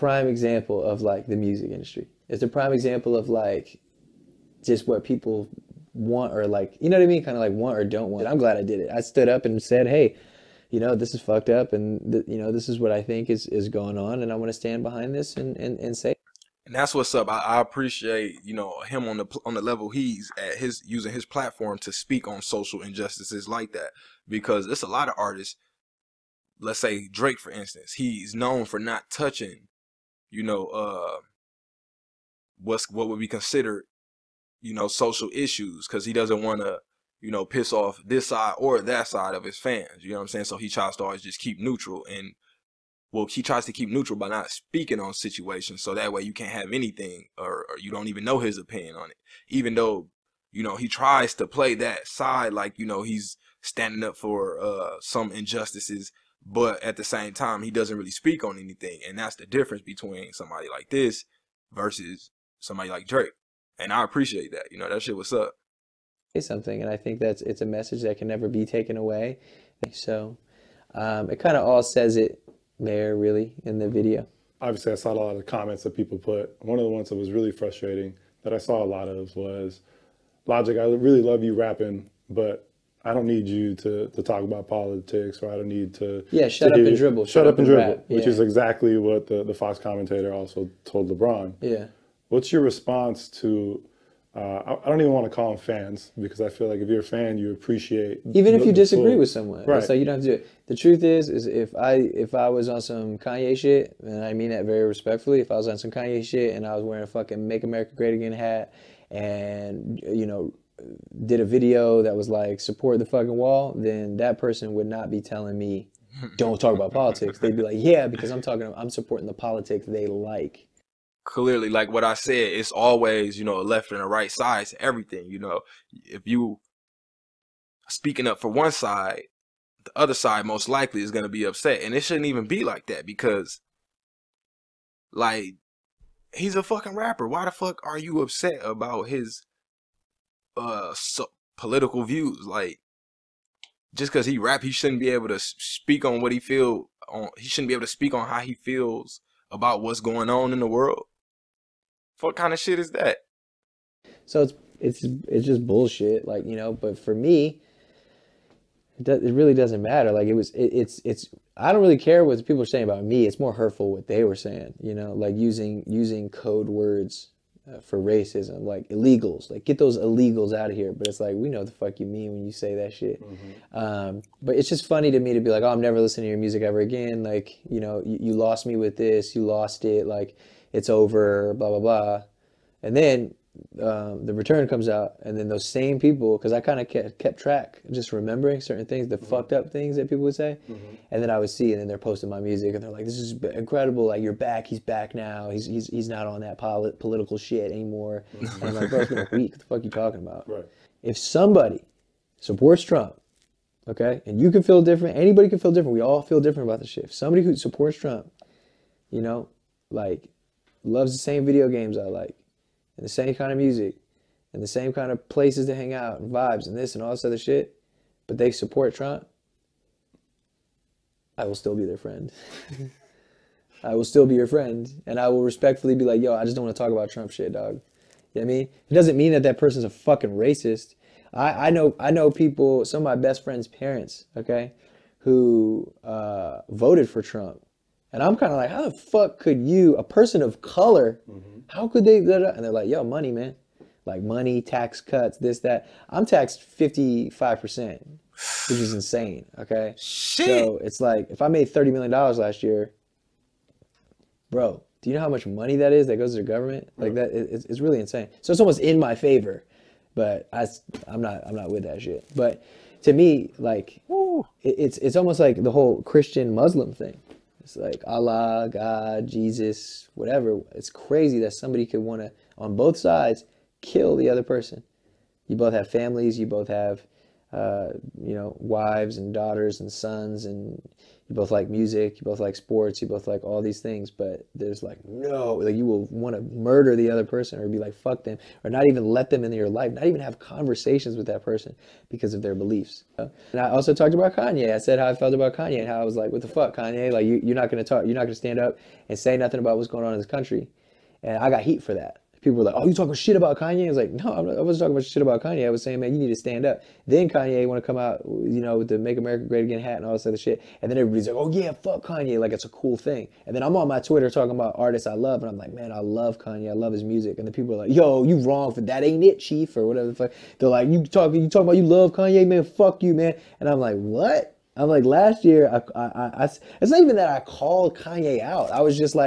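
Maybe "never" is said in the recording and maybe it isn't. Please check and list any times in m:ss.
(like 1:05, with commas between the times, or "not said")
1:08, 2:55.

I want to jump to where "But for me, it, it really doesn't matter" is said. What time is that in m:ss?
2:36.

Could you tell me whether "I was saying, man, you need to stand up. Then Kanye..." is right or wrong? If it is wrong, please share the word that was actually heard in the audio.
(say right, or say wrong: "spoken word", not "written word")
right.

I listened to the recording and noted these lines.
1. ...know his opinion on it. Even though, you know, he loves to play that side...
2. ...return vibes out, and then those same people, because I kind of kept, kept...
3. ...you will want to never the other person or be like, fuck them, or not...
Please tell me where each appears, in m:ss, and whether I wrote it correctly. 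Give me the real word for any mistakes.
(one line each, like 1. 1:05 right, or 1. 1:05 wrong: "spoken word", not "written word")
1. 0:48 wrong: "tries", not "loves"
2. 3:04 wrong: "comes", not "vibes"
3. 4:45 wrong: "murder", not "never".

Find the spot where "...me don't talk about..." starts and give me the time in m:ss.
1:55.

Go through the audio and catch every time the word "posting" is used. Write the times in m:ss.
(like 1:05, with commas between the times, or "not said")
3:11.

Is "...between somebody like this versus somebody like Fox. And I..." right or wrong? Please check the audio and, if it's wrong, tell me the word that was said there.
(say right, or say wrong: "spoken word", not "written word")
wrong: "Drake", not "Fox".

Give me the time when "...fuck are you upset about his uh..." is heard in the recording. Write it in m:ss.
2:17.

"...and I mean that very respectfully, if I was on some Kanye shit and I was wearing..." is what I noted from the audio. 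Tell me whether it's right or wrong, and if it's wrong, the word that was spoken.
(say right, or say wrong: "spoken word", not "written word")
right.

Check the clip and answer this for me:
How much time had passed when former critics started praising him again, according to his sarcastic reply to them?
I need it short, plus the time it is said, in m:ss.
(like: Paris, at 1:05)
a week, at 3:19.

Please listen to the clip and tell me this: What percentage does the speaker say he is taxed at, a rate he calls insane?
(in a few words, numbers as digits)
55%.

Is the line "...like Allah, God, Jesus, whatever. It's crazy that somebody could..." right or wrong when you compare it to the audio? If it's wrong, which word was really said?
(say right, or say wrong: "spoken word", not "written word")
right.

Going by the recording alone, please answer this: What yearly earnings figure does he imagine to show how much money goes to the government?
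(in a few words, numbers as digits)
$30 million.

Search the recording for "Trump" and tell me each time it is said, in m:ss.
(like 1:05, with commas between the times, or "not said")
3:22, 3:27, 3:38, 3:47, 3:57.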